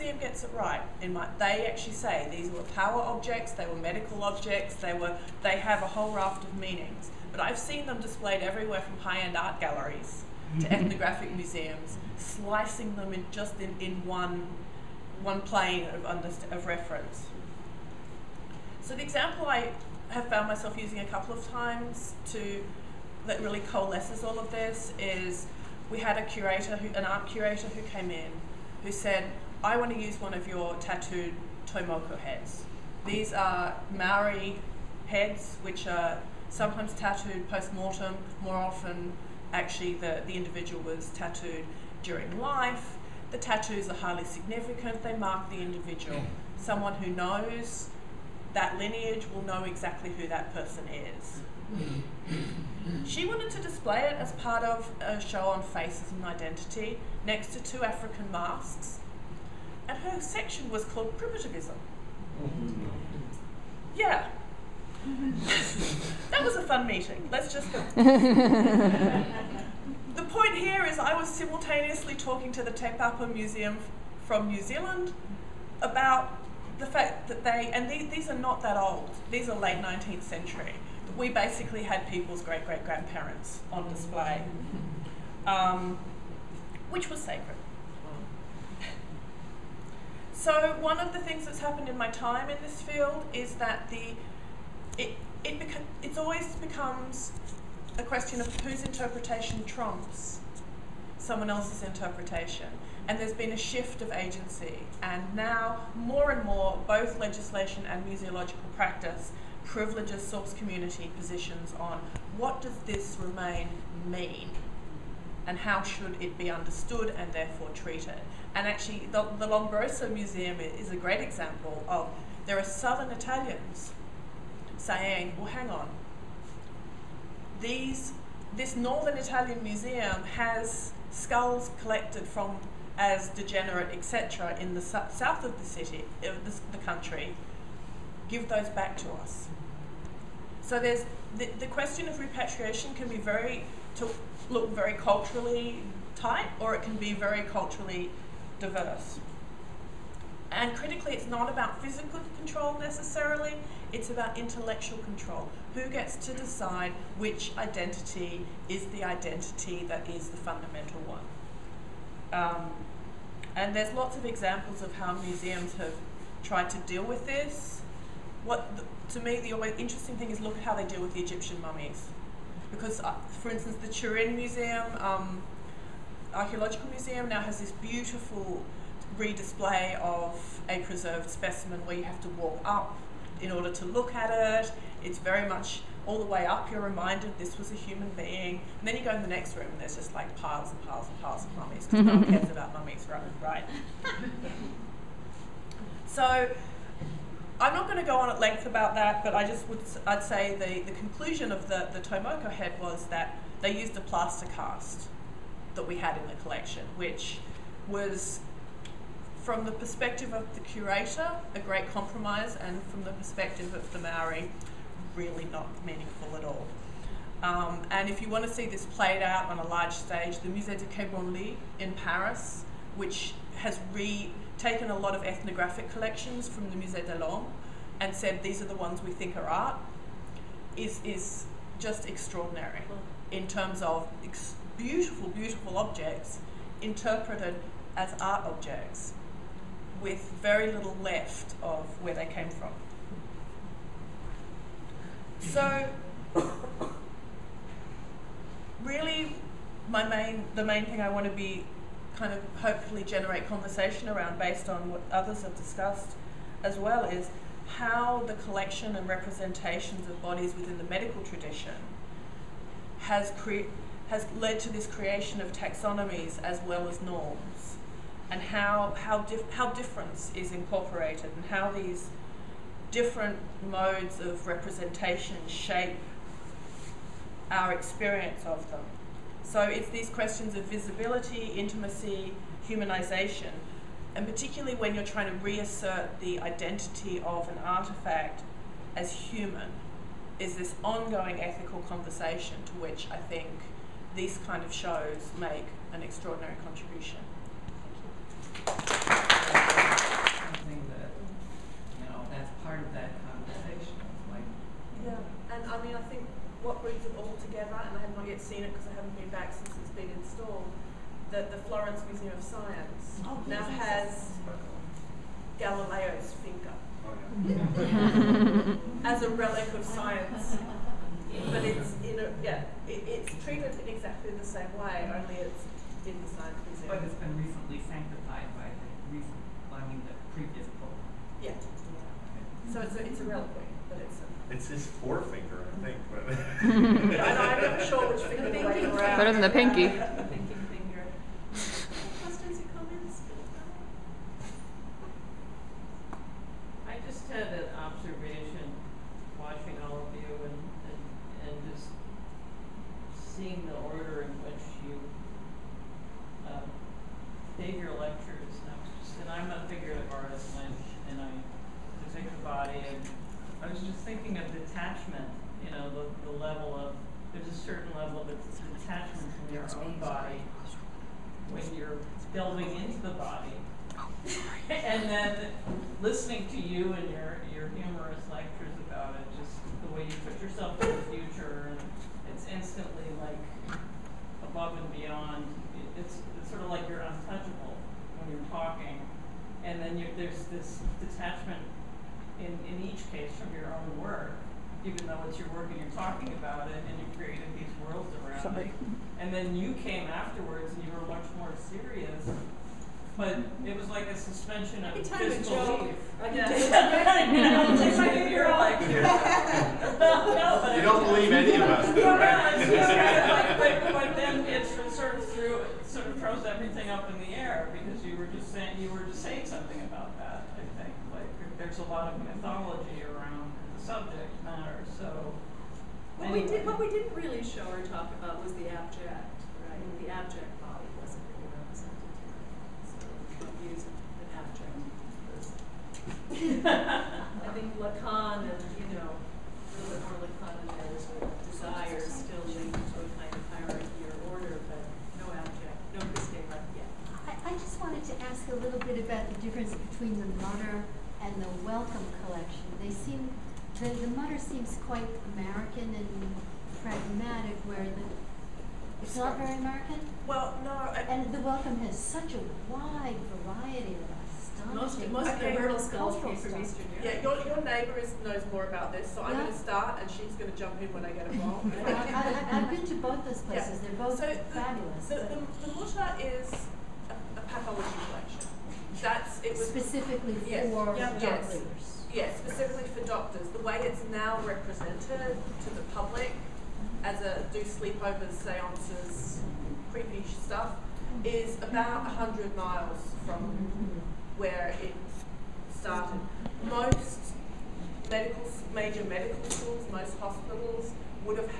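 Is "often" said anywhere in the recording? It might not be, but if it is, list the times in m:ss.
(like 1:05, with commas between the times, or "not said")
0:38.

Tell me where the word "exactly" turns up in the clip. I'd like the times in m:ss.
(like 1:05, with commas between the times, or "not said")
0:49, 5:23.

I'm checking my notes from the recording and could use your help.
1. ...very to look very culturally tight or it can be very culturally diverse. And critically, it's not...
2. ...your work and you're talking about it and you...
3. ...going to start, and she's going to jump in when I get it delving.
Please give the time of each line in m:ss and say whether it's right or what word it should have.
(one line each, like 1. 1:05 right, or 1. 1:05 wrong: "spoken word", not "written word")
1. 2:23 right
2. 6:35 right
3. 7:49 wrong: "wrong", not "delving".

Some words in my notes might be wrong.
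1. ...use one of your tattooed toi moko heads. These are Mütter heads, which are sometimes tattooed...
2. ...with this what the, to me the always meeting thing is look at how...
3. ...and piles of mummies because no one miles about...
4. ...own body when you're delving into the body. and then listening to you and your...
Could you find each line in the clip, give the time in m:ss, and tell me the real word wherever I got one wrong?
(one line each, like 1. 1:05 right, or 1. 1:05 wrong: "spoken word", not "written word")
1. 0:29 wrong: "Maori", not "Mütter"
2. 2:47 wrong: "interesting", not "meeting"
3. 3:11 wrong: "cares", not "miles"
4. 6:09 right.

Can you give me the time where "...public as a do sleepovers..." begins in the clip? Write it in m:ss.
8:05.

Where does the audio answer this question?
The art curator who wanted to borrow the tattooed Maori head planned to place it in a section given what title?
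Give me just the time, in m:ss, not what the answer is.
1:01.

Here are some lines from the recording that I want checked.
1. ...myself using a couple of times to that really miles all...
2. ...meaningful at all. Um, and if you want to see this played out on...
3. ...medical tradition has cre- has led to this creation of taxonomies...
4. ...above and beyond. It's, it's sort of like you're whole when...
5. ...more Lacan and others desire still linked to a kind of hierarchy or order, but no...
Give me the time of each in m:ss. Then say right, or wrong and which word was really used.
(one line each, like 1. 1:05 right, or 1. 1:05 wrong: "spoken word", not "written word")
1. 0:20 wrong: "coalesces", not "miles"
2. 3:35 right
3. 4:20 right
4. 6:24 wrong: "untouchable", not "whole"
5. 7:20 right.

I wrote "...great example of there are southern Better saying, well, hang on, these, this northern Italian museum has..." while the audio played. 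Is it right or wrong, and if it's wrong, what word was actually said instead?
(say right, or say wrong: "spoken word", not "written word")
wrong: "Italians", not "Better".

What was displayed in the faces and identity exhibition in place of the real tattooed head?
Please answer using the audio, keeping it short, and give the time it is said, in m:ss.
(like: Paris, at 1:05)
A plaster cast, at 3:23.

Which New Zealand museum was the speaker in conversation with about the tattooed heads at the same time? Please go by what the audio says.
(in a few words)
Te Papa Museum.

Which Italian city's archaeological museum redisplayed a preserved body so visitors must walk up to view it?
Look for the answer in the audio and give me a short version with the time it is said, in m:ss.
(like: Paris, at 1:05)
Turin, at 2:53.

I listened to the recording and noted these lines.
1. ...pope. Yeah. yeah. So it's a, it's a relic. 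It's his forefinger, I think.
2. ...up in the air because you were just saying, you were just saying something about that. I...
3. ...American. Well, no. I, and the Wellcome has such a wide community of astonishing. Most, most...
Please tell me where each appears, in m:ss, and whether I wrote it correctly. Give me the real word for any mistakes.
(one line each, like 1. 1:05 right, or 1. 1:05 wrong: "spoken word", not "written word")
1. 5:30 right
2. 6:56 right
3. 7:39 wrong: "variety", not "community".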